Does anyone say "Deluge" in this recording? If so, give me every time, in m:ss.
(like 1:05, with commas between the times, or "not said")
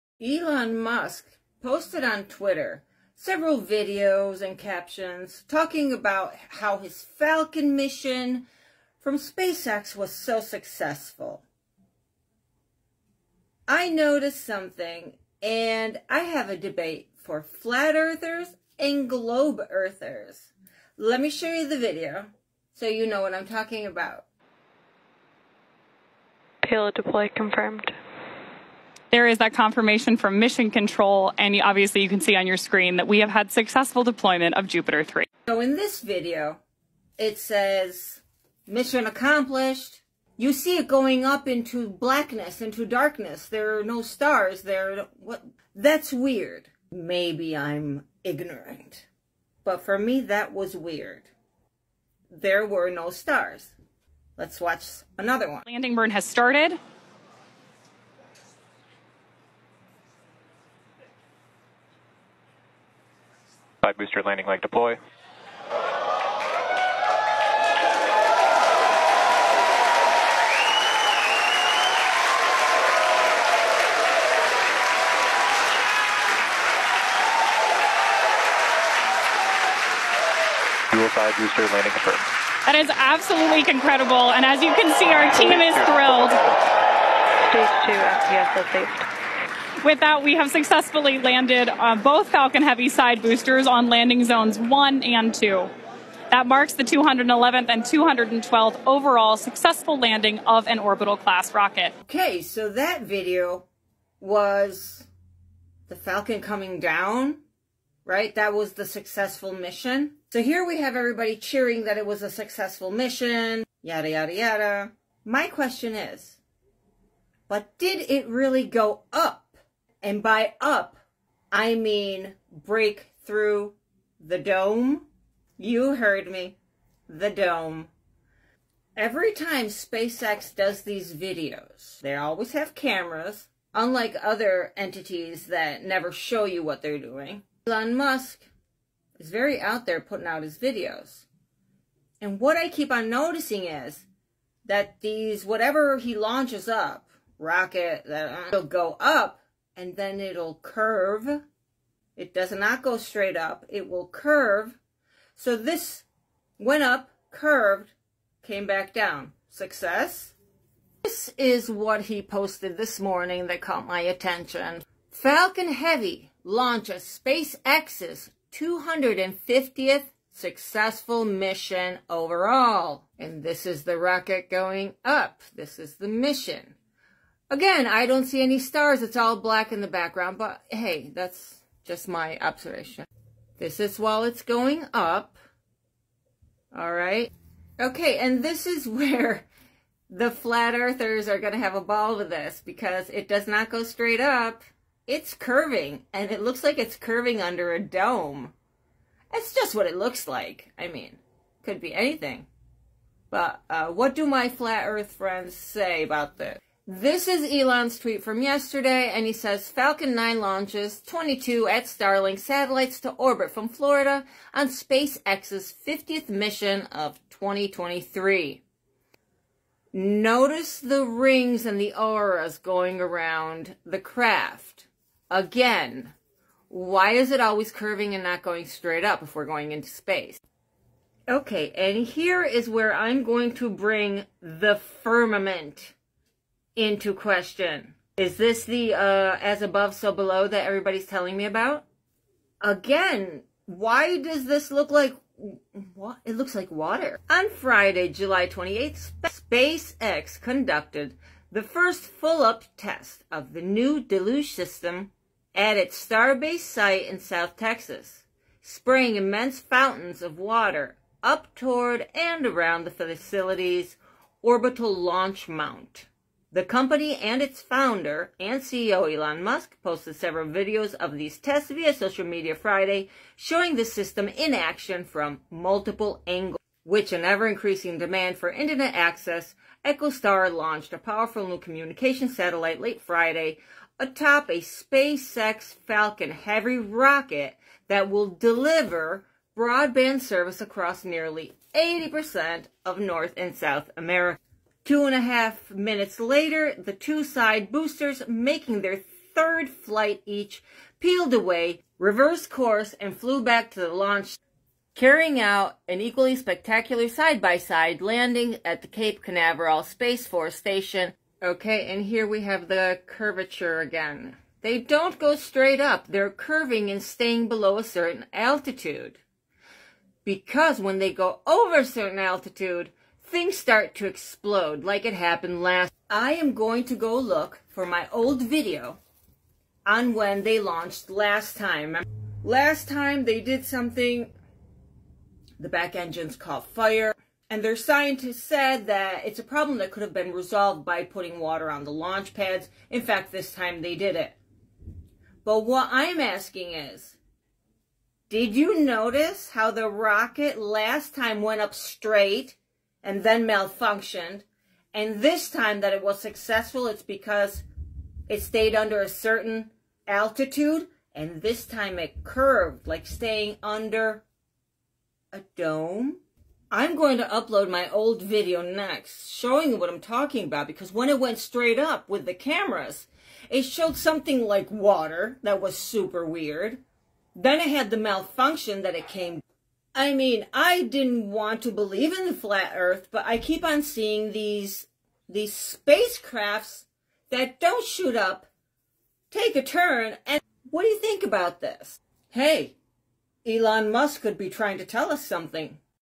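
4:13.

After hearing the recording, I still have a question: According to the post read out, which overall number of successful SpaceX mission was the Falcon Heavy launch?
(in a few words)
250th.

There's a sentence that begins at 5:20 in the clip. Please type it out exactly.
Because when they go over a certain altitude, things start to explode like it happened last.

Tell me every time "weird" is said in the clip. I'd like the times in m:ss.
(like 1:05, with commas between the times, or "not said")
0:46, 0:50, 6:16.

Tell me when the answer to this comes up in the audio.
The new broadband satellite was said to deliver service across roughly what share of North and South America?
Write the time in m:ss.
4:51.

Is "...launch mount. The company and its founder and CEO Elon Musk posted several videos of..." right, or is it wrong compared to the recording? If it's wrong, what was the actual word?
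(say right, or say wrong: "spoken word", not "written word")
right.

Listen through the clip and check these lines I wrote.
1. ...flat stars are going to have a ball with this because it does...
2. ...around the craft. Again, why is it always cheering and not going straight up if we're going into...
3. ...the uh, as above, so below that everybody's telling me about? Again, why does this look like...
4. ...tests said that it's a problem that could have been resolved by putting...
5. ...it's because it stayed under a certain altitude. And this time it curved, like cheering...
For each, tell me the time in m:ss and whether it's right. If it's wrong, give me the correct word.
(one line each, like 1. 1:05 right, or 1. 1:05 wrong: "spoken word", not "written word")
1. 3:10 wrong: "earthers", not "stars"
2. 3:42 wrong: "curving", not "cheering"
3. 3:58 right
4. 5:37 wrong: "scientists", not "tests"
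5. 5:56 wrong: "staying", not "cheering".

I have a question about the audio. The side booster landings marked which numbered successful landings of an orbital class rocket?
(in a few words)
211th and 212th.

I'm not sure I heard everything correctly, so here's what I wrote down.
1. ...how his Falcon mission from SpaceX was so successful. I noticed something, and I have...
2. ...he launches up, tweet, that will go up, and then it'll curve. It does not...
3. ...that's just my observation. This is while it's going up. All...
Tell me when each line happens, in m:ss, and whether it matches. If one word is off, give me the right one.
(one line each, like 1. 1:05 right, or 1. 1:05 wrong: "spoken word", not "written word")
1. 0:06 right
2. 2:25 wrong: "rocket", not "tweet"
3. 3:01 right.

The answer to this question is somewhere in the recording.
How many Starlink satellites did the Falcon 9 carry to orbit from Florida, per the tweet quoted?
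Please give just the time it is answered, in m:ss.
3:31.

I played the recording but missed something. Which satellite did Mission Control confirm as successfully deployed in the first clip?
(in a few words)
Jupiter 3.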